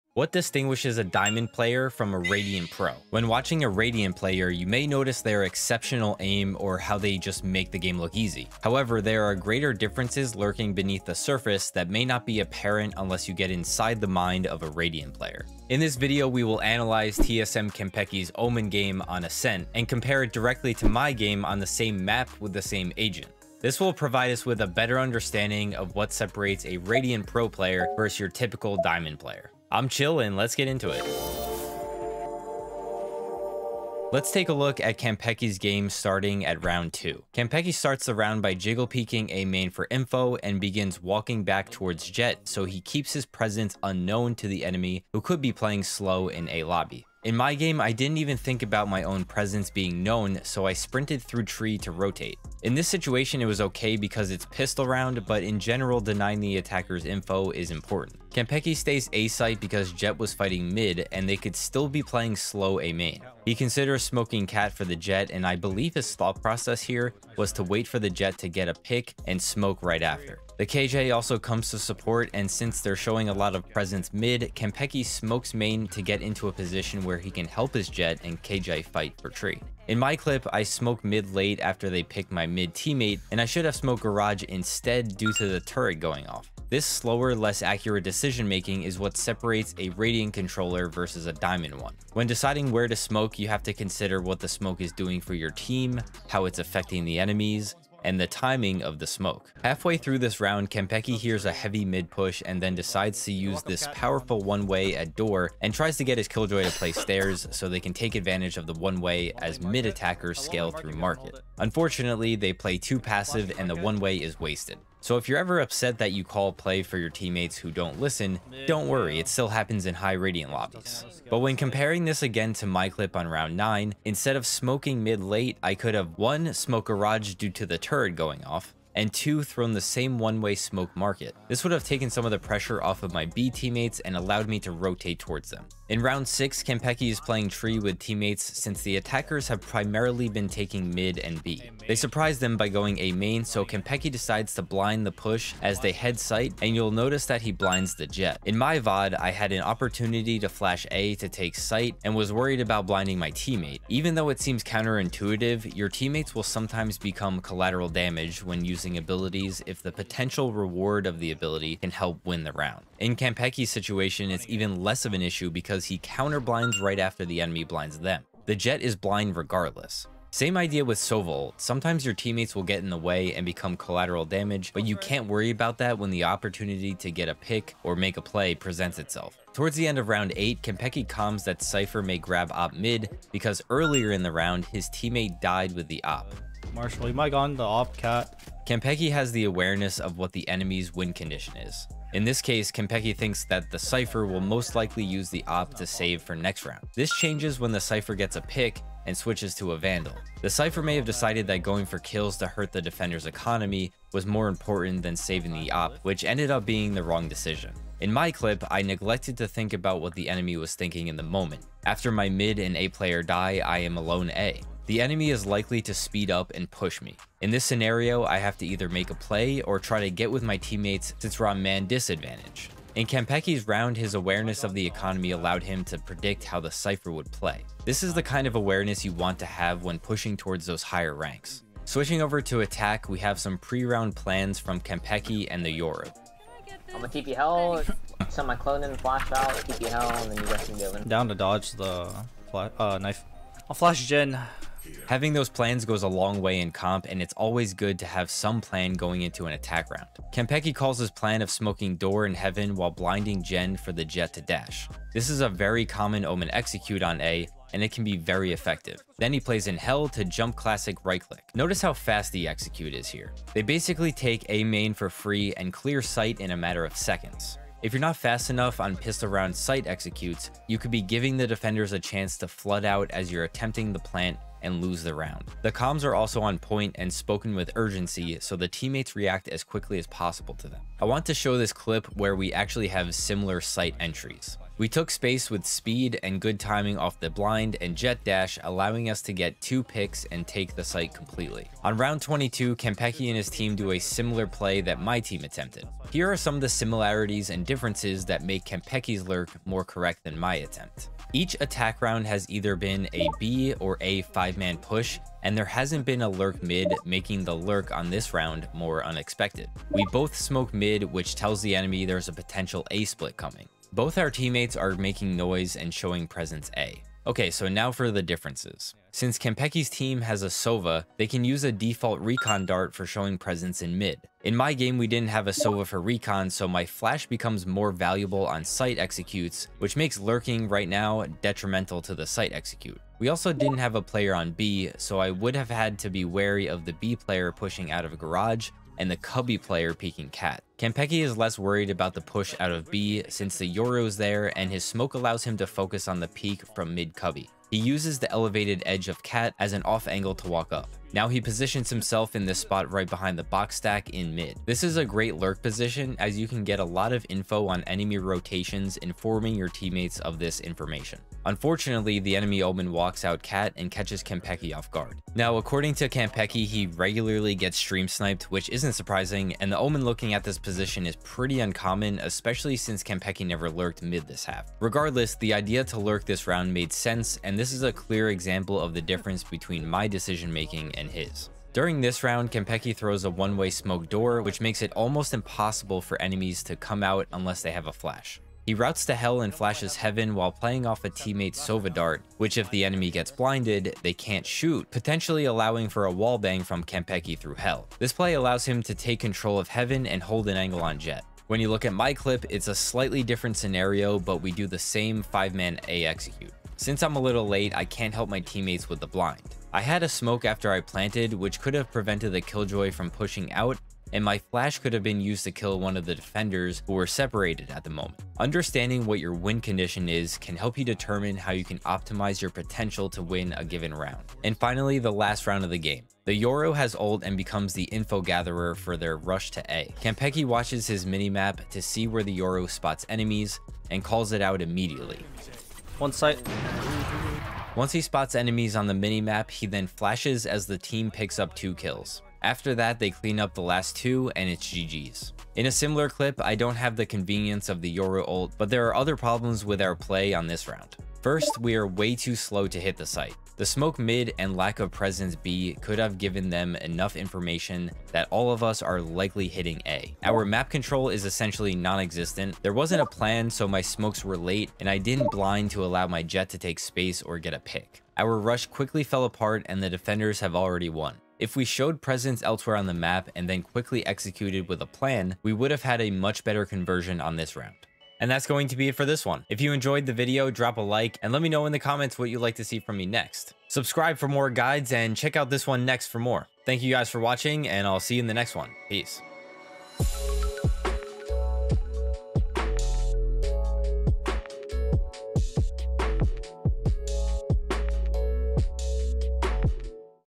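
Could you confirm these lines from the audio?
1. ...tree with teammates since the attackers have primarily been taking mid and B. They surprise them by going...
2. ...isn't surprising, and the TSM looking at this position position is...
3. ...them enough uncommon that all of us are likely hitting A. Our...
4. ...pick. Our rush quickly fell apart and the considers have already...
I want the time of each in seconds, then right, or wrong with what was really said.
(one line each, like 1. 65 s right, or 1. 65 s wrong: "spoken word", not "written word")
1. 137 s right
2. 368 s wrong: "Omen", not "TSM"
3. 456 s wrong: "information", not "uncommon"
4. 467 s wrong: "defenders", not "considers".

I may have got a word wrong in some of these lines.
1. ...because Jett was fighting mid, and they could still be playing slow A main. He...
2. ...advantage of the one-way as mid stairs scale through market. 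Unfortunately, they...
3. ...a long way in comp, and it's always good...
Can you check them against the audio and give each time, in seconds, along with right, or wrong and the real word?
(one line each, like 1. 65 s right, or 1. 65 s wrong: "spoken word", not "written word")
1. 59 s right
2. 108 s wrong: "attackers", not "stairs"
3. 246 s right.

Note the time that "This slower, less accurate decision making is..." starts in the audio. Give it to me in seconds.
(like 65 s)
86 s.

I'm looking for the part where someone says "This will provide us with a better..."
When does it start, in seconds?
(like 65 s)
23 s.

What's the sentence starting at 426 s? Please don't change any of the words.
The Yoru has ult and becomes the info gatherer for their rush to A.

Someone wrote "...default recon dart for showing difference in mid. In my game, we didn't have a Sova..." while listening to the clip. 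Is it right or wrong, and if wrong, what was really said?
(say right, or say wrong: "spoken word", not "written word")
wrong: "presence", not "difference".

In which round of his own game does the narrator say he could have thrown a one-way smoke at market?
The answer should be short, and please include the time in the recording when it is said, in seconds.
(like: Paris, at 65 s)
9, at 123 s.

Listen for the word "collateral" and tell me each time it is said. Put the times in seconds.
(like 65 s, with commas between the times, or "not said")
157 s, 173 s.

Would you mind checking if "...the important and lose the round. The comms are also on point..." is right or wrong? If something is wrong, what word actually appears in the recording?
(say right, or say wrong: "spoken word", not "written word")
wrong: "plant", not "important".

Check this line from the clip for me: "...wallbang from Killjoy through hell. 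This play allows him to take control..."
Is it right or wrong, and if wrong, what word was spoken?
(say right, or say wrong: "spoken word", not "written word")
wrong: "Kanpeki", not "Killjoy".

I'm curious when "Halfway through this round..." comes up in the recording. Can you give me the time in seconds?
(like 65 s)
99 s.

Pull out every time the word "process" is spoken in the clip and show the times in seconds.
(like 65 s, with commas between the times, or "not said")
66 s.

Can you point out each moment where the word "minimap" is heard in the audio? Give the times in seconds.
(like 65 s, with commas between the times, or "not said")
431 s, 438 s.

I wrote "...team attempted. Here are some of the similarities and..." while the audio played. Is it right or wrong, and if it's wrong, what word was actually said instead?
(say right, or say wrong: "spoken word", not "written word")
right.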